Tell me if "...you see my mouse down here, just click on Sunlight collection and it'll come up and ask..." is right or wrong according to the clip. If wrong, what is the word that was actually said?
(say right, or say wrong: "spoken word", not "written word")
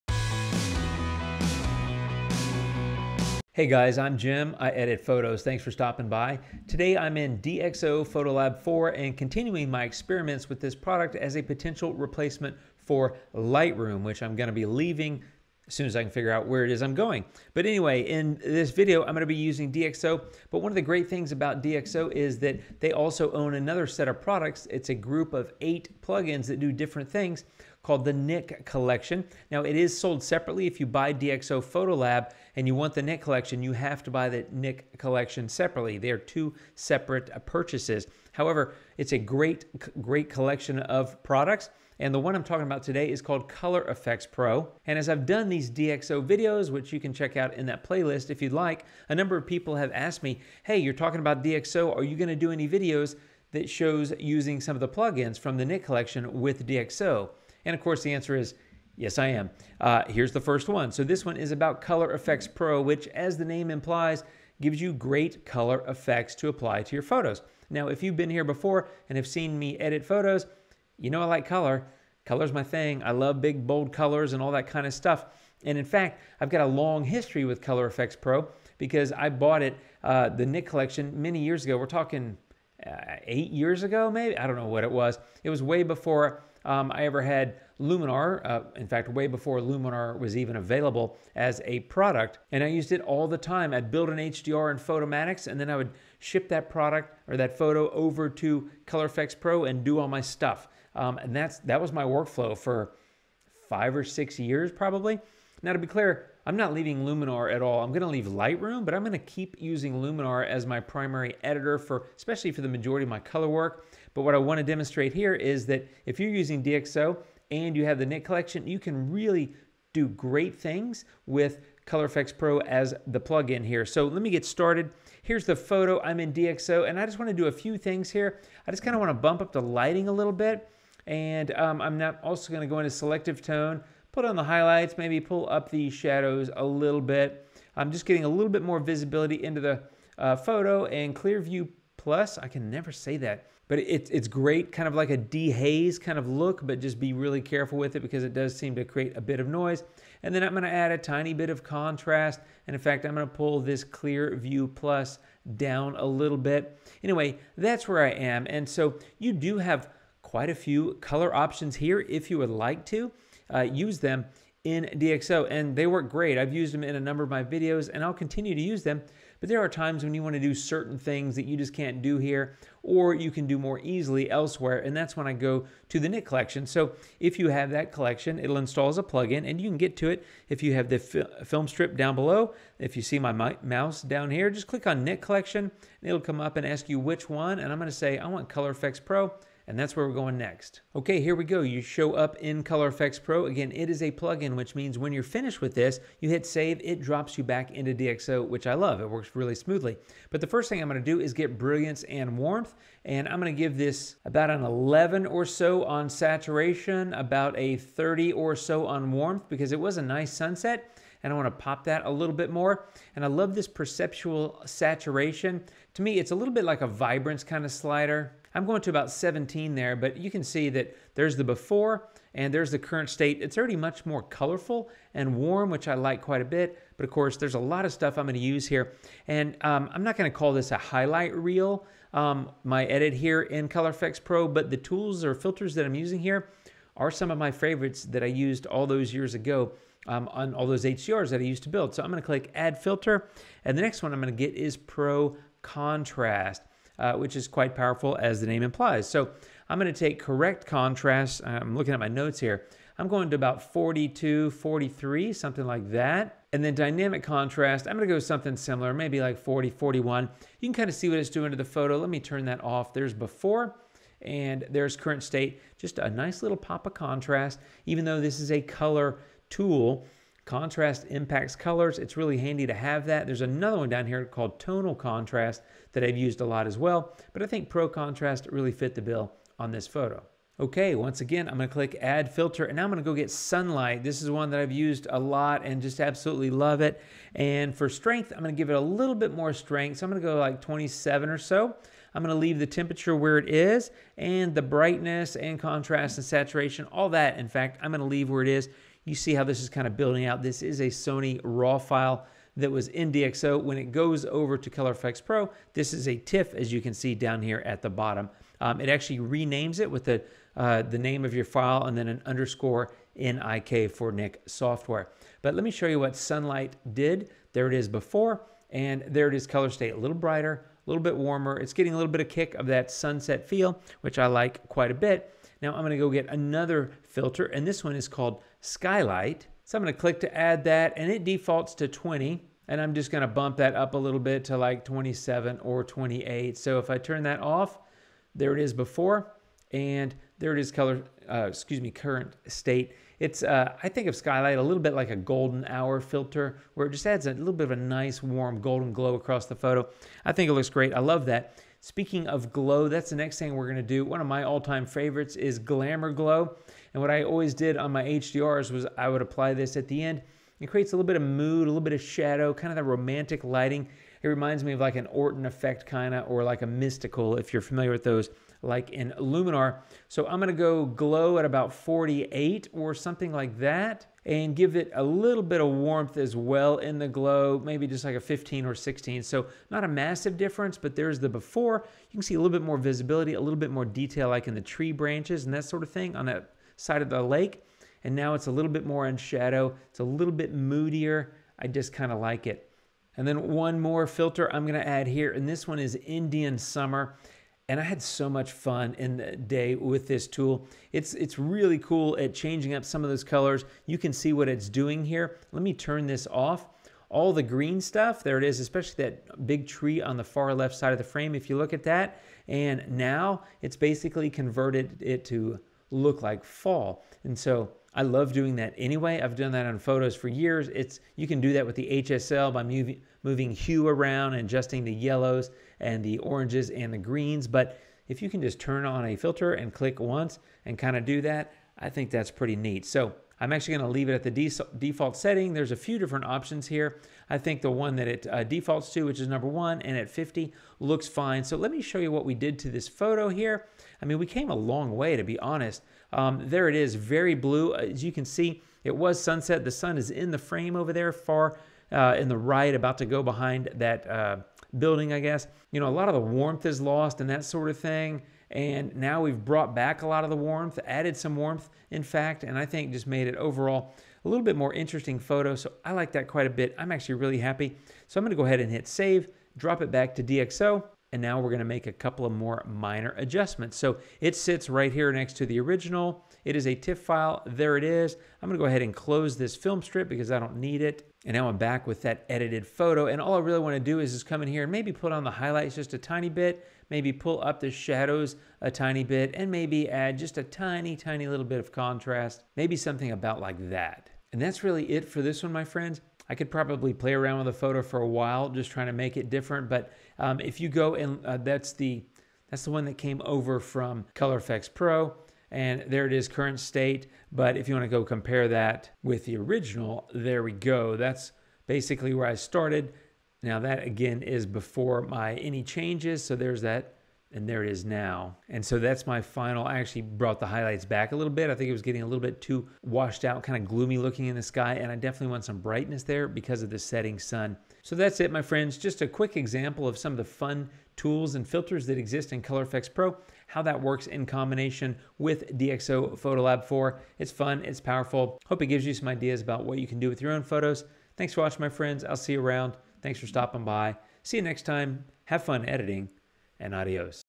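wrong: "Nik", not "Sunlight".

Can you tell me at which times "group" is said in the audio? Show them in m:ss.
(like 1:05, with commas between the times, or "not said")
0:24.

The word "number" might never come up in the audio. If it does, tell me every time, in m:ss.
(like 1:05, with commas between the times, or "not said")
0:49, 2:46, 7:19.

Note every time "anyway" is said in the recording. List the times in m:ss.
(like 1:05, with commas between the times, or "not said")
0:17, 2:37, 6:58.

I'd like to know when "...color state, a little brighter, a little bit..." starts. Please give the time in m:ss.
5:19.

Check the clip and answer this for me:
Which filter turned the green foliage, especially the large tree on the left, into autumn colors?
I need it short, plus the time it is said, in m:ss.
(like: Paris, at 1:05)
Indian Summer, at 6:36.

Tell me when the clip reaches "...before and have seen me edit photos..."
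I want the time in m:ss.
1:08.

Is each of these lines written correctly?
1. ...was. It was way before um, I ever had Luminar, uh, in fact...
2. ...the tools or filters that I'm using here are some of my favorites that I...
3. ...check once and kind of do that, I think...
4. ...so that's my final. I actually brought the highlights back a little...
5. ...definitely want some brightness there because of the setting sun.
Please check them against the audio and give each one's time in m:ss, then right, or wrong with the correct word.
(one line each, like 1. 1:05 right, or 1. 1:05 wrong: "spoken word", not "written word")
1. 1:24 right
2. 3:54 right
3. 7:09 wrong: "click", not "check"
4. 8:38 right
5. 8:44 right.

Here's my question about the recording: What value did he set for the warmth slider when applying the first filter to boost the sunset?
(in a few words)
30.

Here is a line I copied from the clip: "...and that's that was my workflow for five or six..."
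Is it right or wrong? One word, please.
right.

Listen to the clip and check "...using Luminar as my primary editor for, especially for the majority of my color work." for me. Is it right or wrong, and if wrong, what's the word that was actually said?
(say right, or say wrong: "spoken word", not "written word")
right.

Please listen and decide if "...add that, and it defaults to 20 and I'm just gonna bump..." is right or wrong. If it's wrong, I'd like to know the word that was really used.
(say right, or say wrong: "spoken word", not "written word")
right.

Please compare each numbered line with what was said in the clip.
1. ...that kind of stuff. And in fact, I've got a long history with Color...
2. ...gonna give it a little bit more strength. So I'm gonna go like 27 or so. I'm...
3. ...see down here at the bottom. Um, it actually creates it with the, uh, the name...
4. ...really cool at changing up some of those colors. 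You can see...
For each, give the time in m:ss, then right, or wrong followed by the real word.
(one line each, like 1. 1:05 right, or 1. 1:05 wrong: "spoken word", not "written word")
1. 1:14 right
2. 4:48 right
3. 5:06 wrong: "renames", not "creates"
4. 6:41 right.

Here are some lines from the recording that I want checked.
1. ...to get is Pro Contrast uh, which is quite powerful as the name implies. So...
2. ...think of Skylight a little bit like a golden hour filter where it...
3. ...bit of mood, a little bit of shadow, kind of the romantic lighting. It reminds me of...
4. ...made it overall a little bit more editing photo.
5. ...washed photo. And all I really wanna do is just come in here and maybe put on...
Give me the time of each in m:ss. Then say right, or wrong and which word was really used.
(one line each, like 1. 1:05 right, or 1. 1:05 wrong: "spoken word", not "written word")
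1. 4:04 right
2. 5:43 right
3. 6:01 right
4. 7:43 wrong: "interesting", not "editing"
5. 8:02 wrong: "edited", not "washed".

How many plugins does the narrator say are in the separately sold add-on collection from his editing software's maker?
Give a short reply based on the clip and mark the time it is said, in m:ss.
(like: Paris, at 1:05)
8, at 0:25.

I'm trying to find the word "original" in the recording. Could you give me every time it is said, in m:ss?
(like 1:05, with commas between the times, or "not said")
7:55, 8:29.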